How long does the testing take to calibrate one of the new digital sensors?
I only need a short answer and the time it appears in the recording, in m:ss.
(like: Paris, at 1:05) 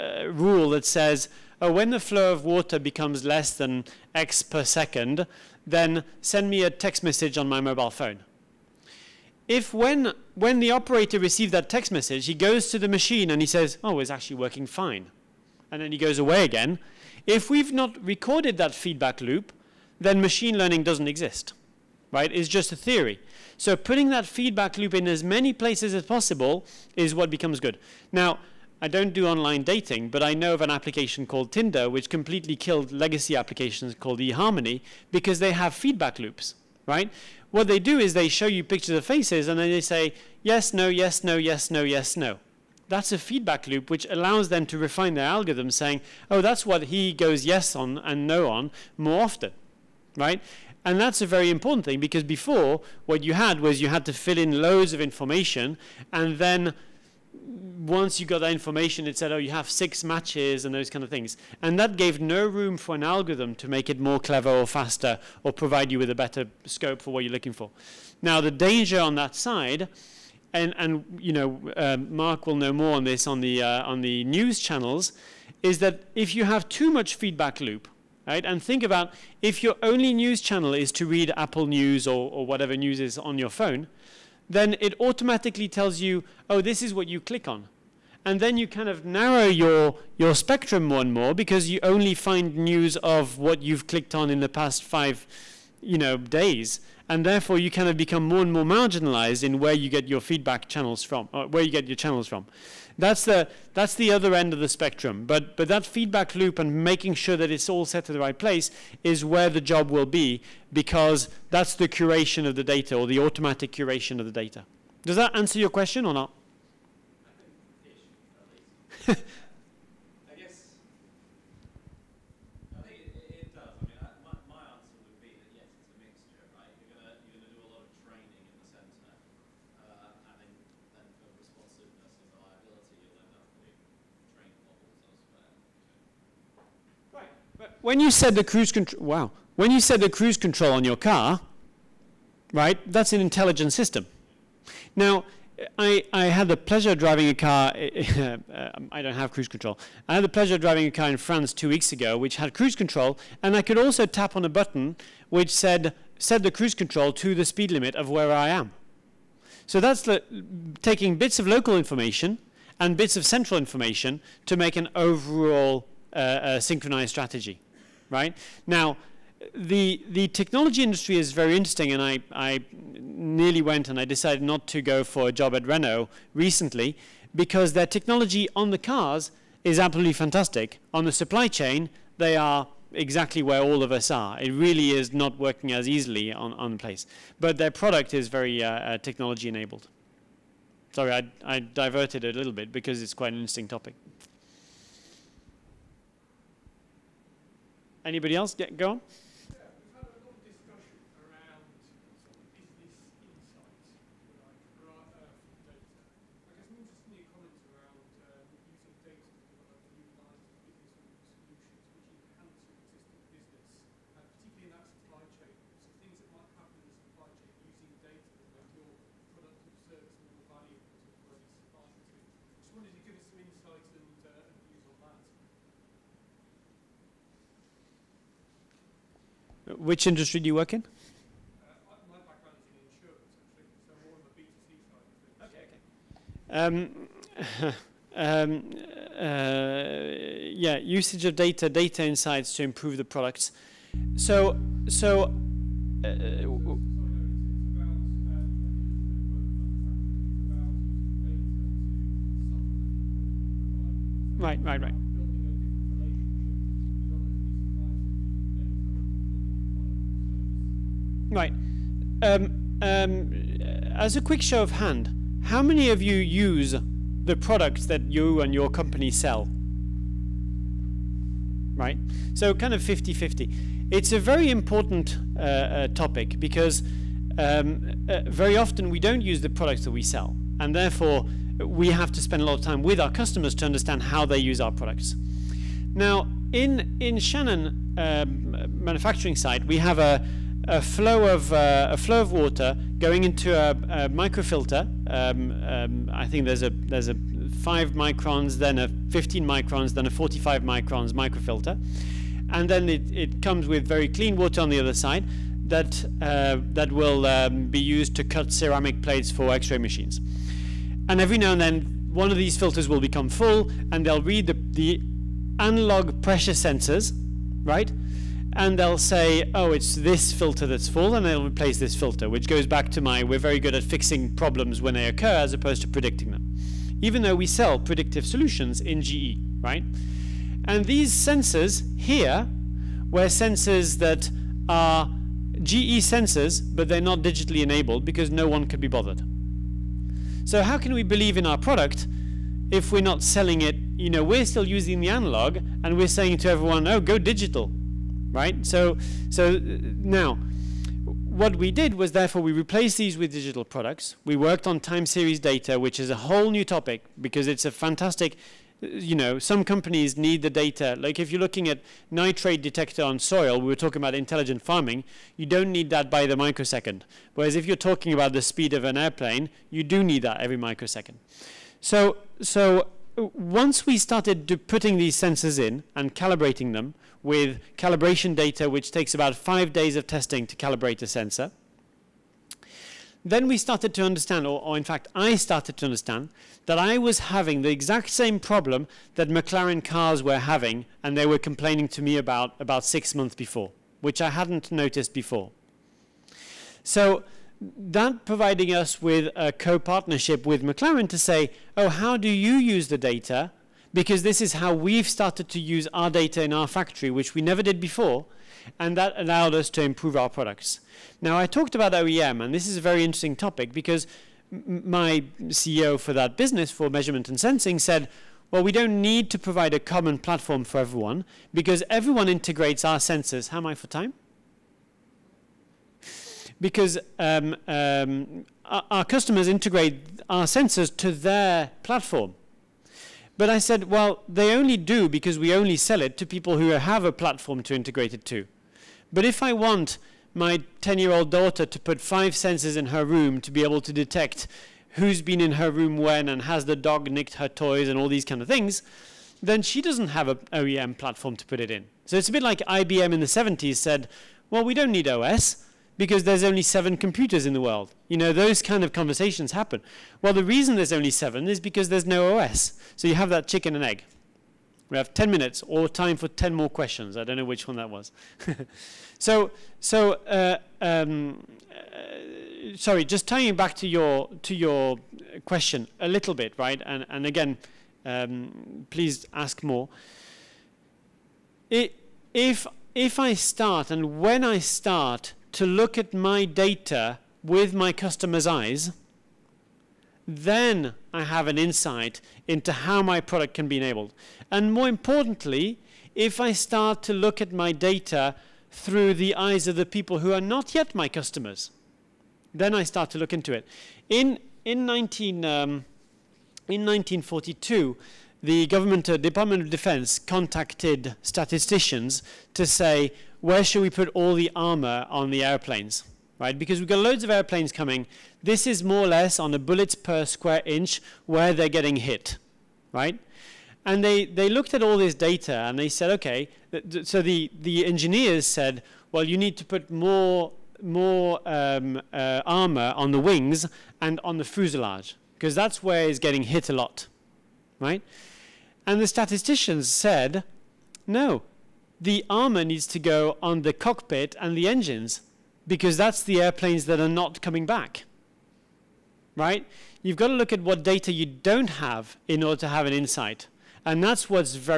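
5 days, at 6:19.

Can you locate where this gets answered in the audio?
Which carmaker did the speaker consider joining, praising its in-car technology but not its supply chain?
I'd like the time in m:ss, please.
2:55.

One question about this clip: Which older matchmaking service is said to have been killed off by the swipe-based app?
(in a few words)
eHarmony.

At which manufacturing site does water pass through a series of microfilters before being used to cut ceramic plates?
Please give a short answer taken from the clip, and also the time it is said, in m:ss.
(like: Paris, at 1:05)
Shannon, at 4:47.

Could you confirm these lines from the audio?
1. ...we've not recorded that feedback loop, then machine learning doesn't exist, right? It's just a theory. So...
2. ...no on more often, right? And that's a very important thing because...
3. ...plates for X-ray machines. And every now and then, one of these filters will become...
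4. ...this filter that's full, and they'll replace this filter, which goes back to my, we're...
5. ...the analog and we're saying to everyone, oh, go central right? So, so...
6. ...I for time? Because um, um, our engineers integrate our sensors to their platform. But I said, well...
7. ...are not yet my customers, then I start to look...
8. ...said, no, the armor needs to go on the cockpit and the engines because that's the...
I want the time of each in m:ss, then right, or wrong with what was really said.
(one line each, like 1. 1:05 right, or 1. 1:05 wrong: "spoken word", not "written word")
1. 0:17 right
2. 0:48 right
3. 5:09 right
4. 5:19 right
5. 5:44 wrong: "digital", not "central"
6. 7:03 wrong: "customers", not "engineers"
7. 8:20 right
8. 8:59 right.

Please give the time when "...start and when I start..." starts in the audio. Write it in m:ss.
8:03.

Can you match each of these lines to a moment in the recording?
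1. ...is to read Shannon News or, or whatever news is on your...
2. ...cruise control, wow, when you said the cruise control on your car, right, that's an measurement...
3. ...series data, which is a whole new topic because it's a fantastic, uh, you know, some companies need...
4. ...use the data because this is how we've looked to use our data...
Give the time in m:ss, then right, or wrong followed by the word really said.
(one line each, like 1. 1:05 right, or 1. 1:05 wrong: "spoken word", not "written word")
1. 1:20 wrong: "Apple", not "Shannon"
2. 2:18 wrong: "intelligent", not "measurement"
3. 5:55 right
4. 6:42 wrong: "started", not "looked".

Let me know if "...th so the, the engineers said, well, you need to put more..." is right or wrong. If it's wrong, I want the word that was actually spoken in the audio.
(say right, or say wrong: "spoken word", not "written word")
right.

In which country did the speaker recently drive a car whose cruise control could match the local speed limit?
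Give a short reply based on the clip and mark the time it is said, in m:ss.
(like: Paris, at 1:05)
France, at 2:31.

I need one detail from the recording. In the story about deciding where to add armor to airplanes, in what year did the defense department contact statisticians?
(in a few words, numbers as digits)
1942.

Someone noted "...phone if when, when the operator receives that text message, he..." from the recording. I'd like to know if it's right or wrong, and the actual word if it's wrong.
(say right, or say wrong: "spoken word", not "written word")
right.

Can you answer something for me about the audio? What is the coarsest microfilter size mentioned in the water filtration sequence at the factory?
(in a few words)
45 microns.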